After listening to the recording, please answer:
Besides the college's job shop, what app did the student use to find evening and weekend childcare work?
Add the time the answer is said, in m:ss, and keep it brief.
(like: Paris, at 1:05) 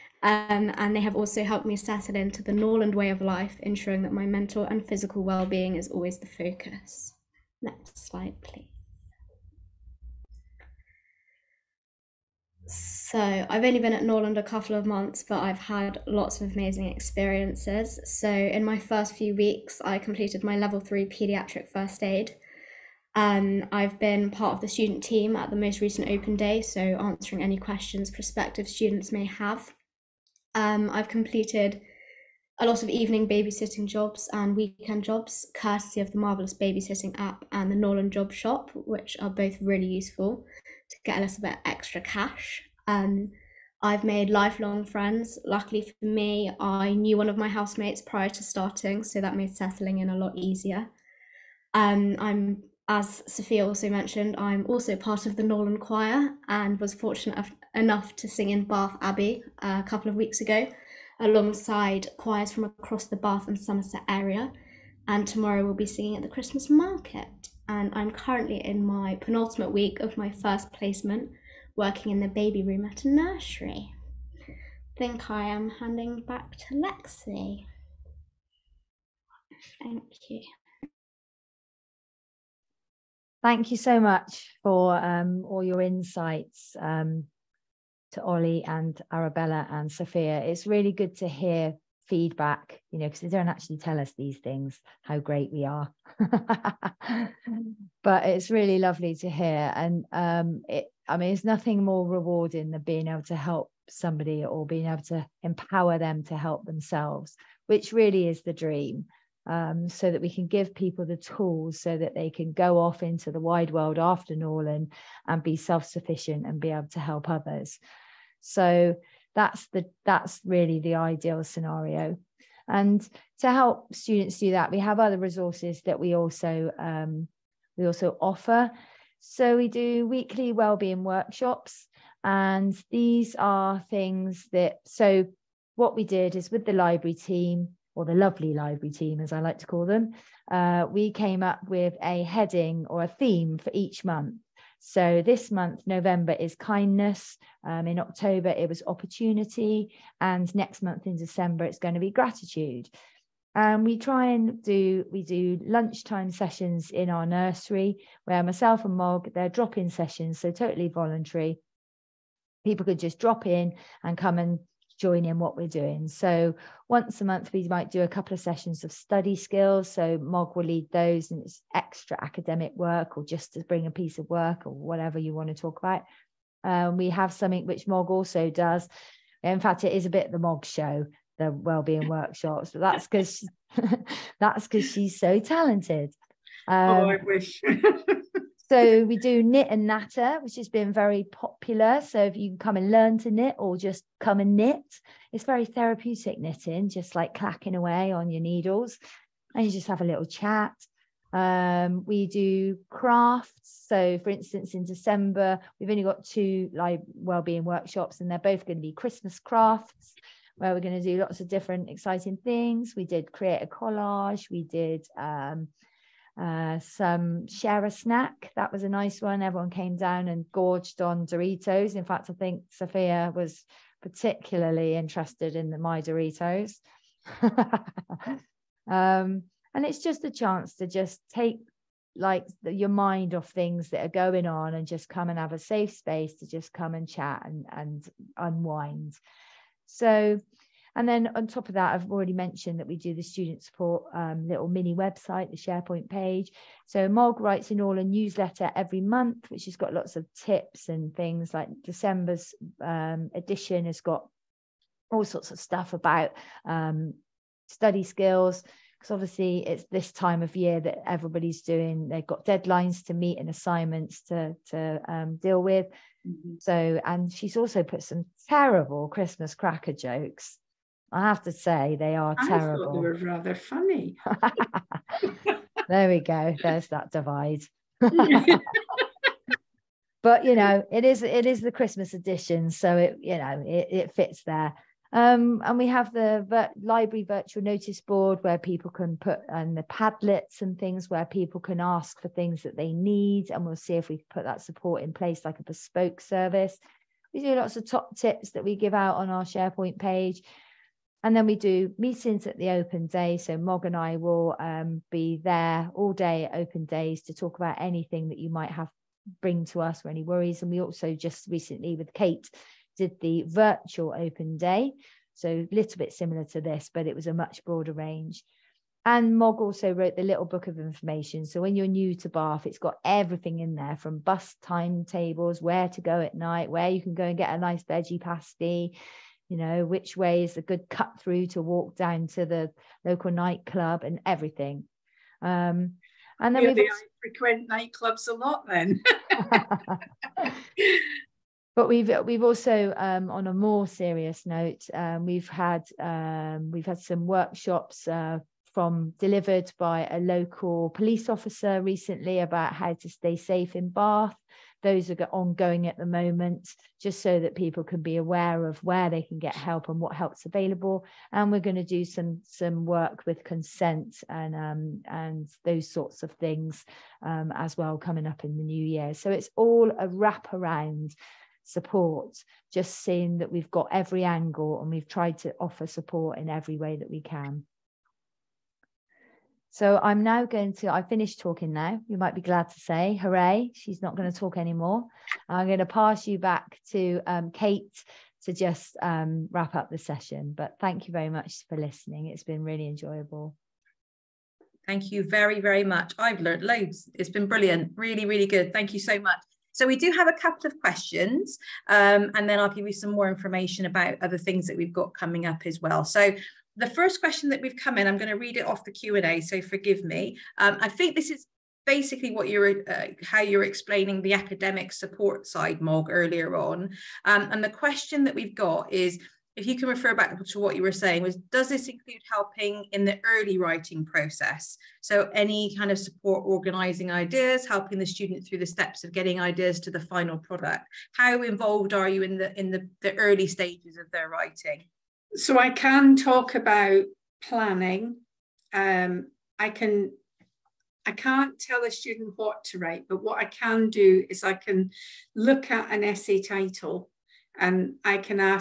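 Marvellous Babysitting app, at 0:36.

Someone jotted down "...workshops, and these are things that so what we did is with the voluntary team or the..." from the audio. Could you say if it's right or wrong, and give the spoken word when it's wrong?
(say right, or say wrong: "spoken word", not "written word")
wrong: "library", not "voluntary".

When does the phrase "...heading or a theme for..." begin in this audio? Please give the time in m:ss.
2:22.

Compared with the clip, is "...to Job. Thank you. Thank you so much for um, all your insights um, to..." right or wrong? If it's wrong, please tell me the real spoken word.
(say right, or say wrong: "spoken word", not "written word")
wrong: "Lexi", not "Job".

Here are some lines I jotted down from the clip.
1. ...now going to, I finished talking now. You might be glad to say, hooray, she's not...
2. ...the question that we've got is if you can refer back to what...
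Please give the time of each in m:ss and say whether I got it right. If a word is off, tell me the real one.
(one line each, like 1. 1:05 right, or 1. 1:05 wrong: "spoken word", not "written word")
1. 6:20 right
2. 6:57 right.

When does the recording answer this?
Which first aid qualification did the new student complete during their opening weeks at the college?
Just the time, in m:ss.
0:20.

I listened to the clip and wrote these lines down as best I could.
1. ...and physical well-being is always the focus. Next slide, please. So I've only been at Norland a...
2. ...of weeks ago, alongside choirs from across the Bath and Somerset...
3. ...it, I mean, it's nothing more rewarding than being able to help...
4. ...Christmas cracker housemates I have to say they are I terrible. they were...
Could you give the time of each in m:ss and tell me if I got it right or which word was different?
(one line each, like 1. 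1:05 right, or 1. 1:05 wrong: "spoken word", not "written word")
1. 0:04 right
2. 1:00 right
3. 1:40 right
4. 4:29 wrong: "jokes", not "housemates".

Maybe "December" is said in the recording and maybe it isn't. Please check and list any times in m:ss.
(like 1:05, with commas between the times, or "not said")
2:31, 3:24, 4:11.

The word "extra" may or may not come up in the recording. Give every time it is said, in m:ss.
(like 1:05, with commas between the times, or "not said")
0:41, 2:51.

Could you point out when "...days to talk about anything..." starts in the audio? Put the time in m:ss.
5:06.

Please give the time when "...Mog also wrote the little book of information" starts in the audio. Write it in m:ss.
5:19.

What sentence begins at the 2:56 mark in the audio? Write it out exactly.
Um, we have something which Mog also does.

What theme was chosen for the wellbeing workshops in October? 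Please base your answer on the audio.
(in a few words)
Opportunity.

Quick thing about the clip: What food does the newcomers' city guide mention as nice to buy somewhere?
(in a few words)
Veggie pasty.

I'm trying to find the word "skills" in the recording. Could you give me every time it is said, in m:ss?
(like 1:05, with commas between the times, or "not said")
2:49, 4:18.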